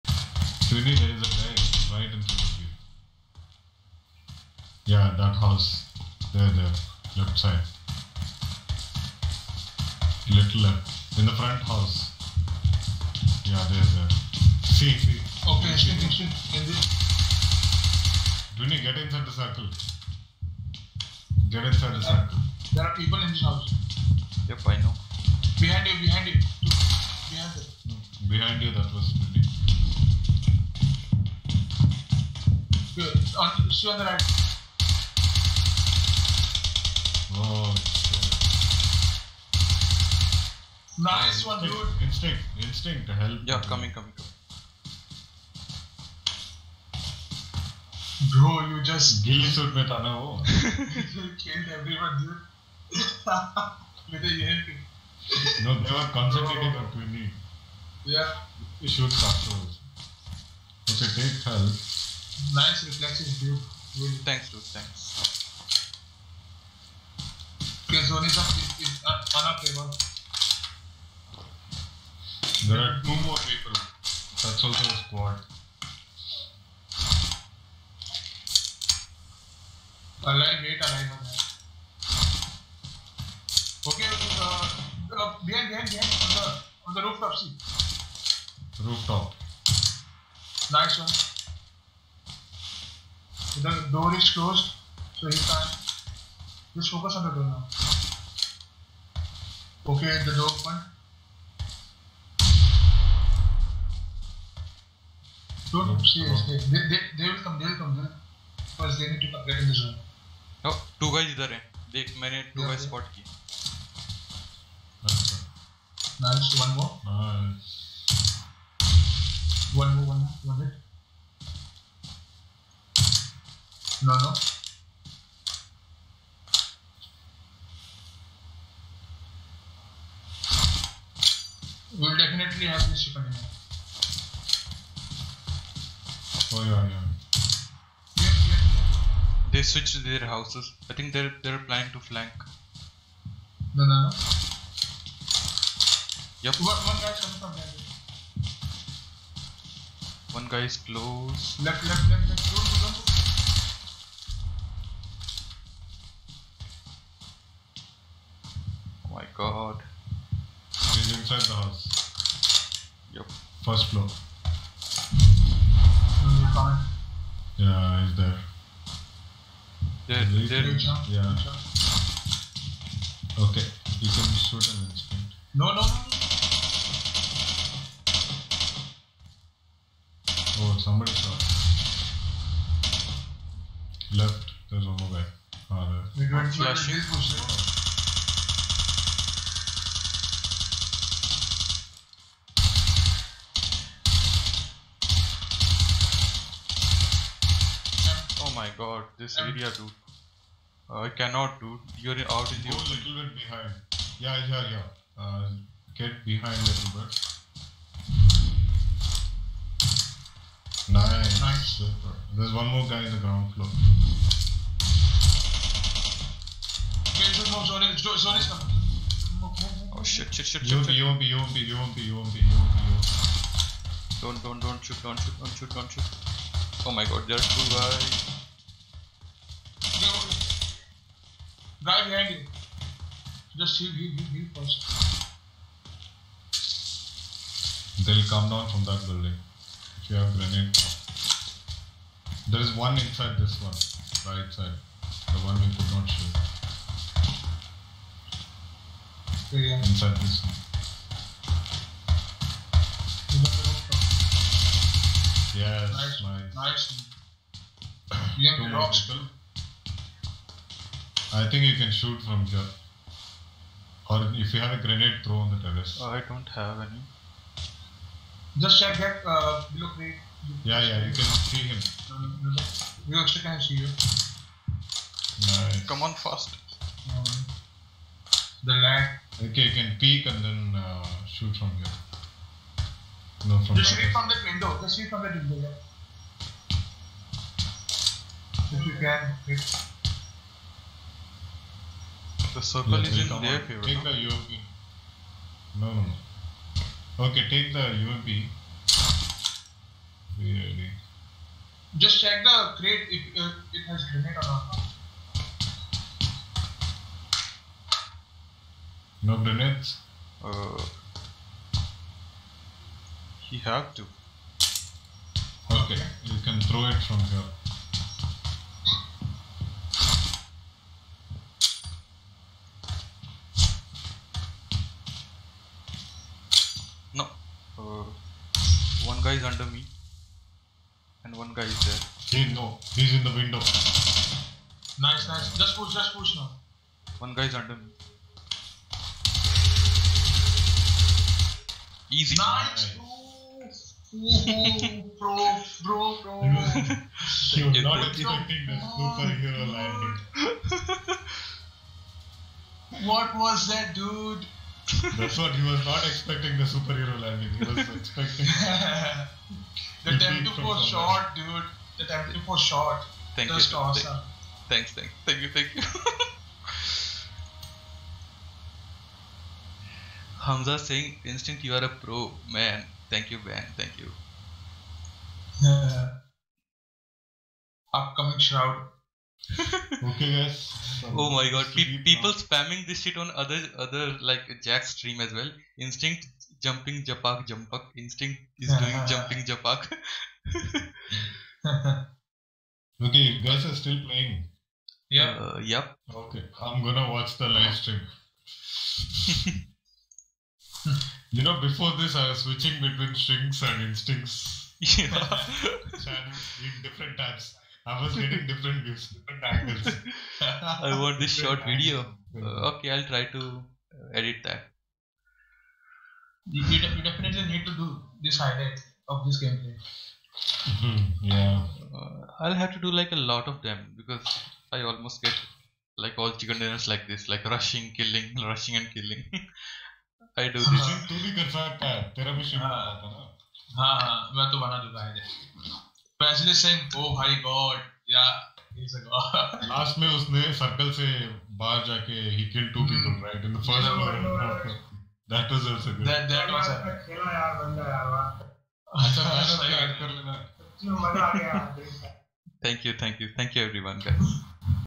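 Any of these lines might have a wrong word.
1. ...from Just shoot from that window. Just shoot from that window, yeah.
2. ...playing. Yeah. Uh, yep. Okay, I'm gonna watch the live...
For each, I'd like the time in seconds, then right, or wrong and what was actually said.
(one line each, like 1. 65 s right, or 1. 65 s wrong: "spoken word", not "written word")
1. 283 s right
2. 394 s right.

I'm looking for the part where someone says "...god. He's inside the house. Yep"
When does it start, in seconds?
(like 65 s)
159 s.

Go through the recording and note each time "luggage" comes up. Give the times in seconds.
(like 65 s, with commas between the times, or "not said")
not said.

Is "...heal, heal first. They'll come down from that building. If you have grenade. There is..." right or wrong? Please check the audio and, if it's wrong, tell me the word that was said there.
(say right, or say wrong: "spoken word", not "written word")
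right.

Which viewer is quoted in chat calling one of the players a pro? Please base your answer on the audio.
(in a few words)
Hamza.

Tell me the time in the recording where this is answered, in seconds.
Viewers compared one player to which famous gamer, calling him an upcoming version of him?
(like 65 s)
377 s.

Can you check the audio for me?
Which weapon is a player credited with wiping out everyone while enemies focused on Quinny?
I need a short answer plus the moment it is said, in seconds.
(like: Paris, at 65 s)
EMP, at 54 s.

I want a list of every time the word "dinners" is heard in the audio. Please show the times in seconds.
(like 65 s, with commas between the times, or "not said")
426 s.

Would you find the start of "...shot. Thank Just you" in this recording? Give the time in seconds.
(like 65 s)
362 s.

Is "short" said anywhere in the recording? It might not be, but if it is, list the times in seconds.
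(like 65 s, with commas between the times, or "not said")
411 s.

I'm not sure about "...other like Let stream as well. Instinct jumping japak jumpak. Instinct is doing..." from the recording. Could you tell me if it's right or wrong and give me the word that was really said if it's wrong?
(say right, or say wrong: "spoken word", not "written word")
wrong: "Jack", not "Let".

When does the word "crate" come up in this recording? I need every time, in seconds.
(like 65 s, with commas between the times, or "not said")
269 s, 302 s.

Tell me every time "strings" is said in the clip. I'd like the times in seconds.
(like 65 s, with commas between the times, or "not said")
403 s.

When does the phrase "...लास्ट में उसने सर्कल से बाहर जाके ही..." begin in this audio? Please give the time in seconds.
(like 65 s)
438 s.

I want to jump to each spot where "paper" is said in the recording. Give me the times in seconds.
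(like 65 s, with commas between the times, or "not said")
69 s.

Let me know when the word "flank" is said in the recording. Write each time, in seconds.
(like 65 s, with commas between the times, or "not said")
141 s.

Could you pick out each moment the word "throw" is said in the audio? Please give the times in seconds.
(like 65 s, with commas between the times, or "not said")
265 s, 316 s.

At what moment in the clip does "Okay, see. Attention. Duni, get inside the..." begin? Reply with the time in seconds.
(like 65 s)
15 s.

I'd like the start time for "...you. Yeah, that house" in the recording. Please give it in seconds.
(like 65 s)
2 s.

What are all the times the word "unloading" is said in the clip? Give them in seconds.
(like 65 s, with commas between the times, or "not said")
not said.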